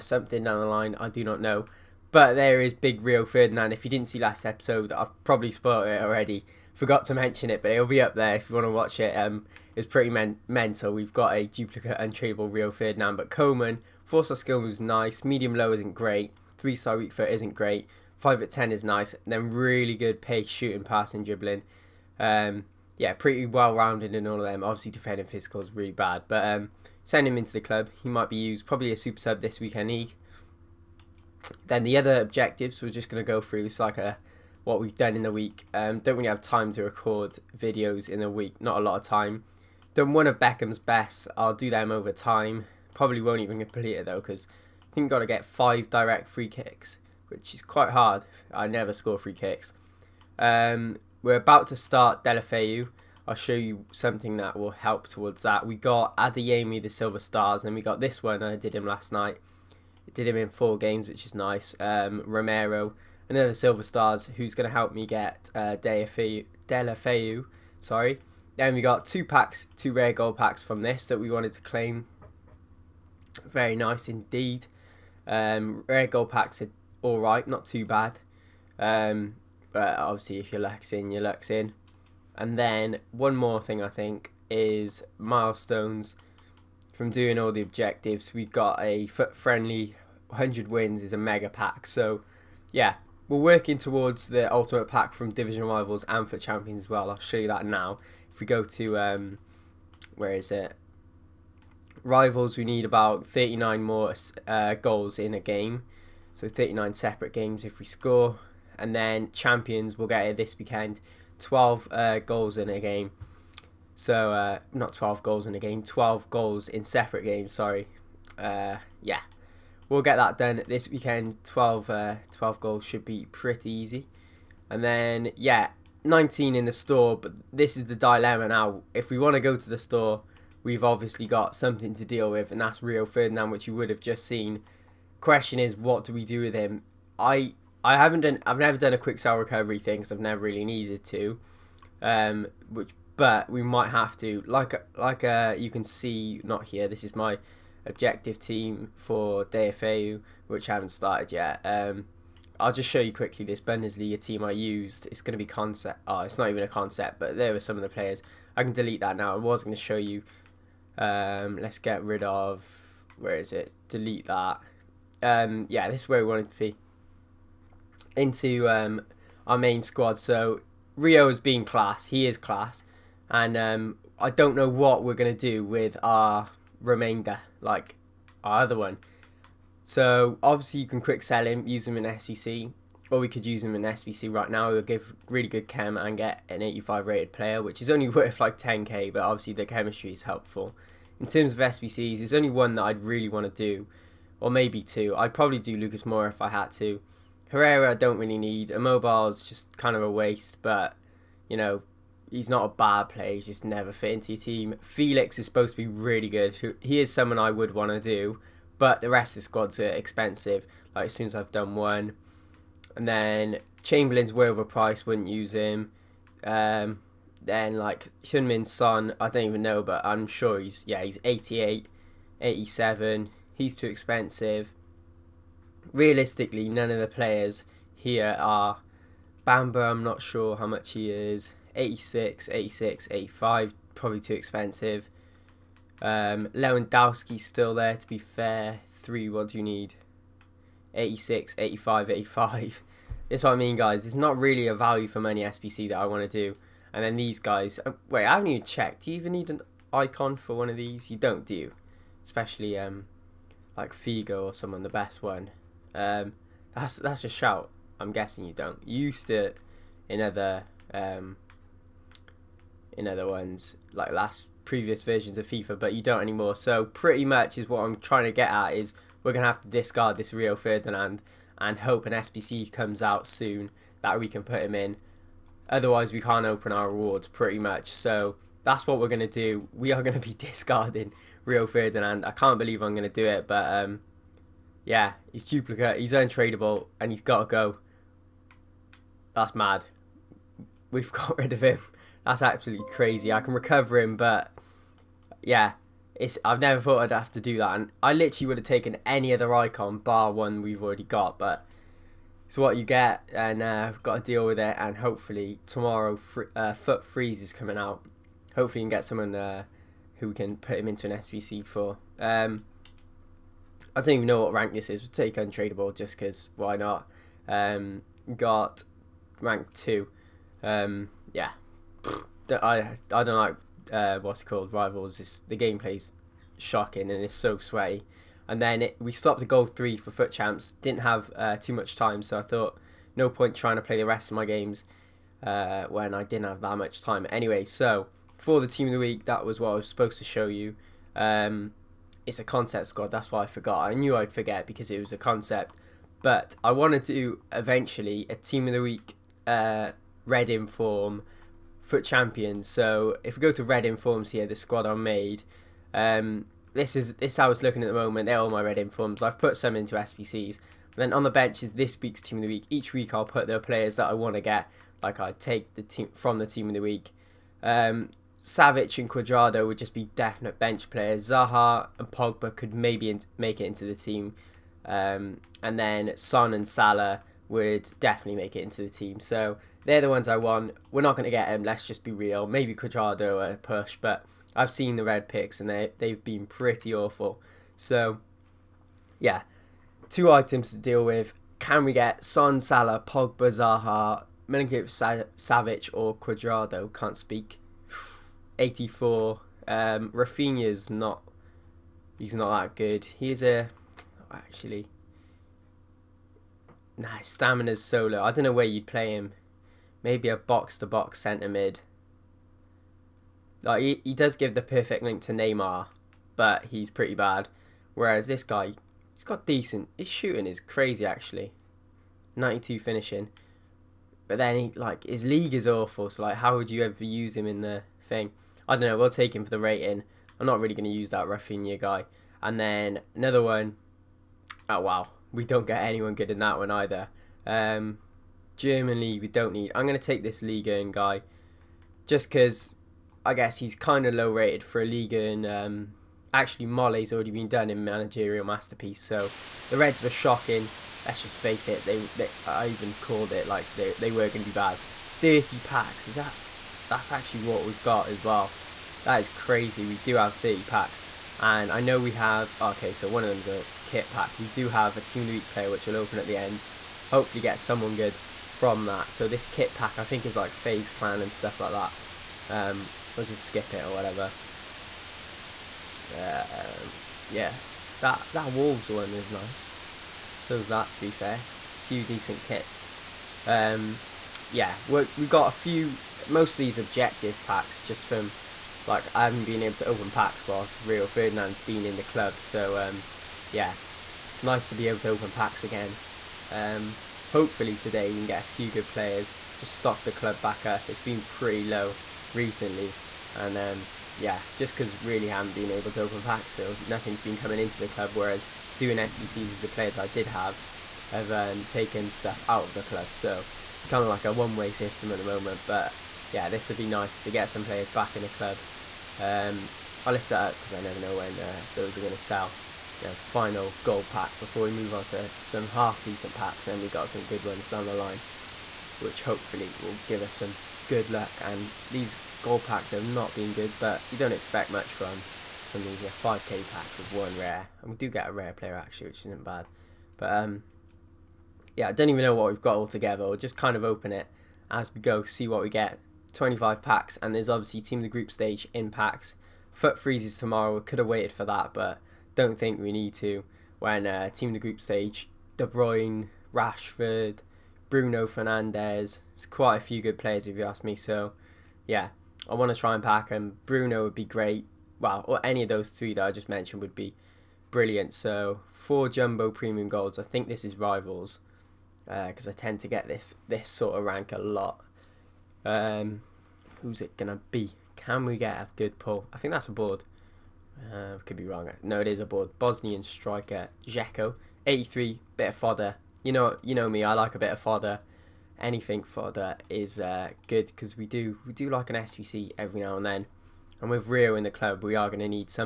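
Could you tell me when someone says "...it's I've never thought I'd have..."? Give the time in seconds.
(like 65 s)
296 s.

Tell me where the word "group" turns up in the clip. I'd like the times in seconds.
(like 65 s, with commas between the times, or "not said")
548 s, 554 s.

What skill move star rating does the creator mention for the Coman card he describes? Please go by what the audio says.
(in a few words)
4 star.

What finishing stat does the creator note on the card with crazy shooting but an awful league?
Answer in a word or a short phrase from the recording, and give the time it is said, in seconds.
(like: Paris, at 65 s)
92, at 422 s.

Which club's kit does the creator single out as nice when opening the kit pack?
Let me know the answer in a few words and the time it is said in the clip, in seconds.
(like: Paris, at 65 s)
Wolves, at 478 s.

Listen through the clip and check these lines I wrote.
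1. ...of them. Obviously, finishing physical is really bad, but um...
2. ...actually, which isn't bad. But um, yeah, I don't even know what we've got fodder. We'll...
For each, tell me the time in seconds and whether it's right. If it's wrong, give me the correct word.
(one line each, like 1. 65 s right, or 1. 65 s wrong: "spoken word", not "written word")
1. 24 s wrong: "defending", not "finishing"
2. 538 s wrong: "altogether", not "fodder".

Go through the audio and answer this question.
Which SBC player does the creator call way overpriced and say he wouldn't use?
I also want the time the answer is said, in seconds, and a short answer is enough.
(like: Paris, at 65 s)
Chamberlain, at 213 s.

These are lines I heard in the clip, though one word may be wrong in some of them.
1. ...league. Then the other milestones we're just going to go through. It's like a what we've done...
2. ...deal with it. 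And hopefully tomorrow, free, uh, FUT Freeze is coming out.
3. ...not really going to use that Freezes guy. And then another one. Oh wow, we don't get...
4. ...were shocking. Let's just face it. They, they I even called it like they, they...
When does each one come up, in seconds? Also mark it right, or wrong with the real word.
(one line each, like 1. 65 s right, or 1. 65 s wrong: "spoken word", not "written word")
1. 29 s wrong: "objectives", not "milestones"
2. 304 s right
3. 430 s wrong: "Rafinha", not "Freezes"
4. 450 s right.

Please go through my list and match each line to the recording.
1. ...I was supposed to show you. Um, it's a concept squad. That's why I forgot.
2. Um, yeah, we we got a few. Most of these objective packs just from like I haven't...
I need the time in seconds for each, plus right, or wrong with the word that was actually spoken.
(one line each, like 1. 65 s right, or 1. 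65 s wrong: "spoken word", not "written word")
1. 339 s right
2. 483 s right.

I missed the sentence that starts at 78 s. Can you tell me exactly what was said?
Um, but obviously if you're in, you're in.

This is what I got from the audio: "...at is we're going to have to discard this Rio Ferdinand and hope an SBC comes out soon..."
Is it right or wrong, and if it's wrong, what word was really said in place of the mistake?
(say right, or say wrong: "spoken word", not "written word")
right.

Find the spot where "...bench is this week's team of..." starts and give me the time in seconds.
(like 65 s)
361 s.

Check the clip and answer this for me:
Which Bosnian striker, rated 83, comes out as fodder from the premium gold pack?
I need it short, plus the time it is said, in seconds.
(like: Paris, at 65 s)
Dzeko, at 583 s.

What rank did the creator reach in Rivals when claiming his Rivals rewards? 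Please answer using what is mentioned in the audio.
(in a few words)
Rank 2.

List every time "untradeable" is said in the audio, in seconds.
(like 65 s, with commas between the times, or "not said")
11 s, 286 s, 315 s.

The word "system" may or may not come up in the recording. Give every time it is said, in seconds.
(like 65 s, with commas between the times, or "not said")
514 s.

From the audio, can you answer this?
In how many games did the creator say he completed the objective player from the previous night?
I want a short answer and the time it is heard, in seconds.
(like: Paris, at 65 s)
4, at 60 s.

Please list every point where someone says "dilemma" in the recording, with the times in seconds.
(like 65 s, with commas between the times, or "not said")
127 s.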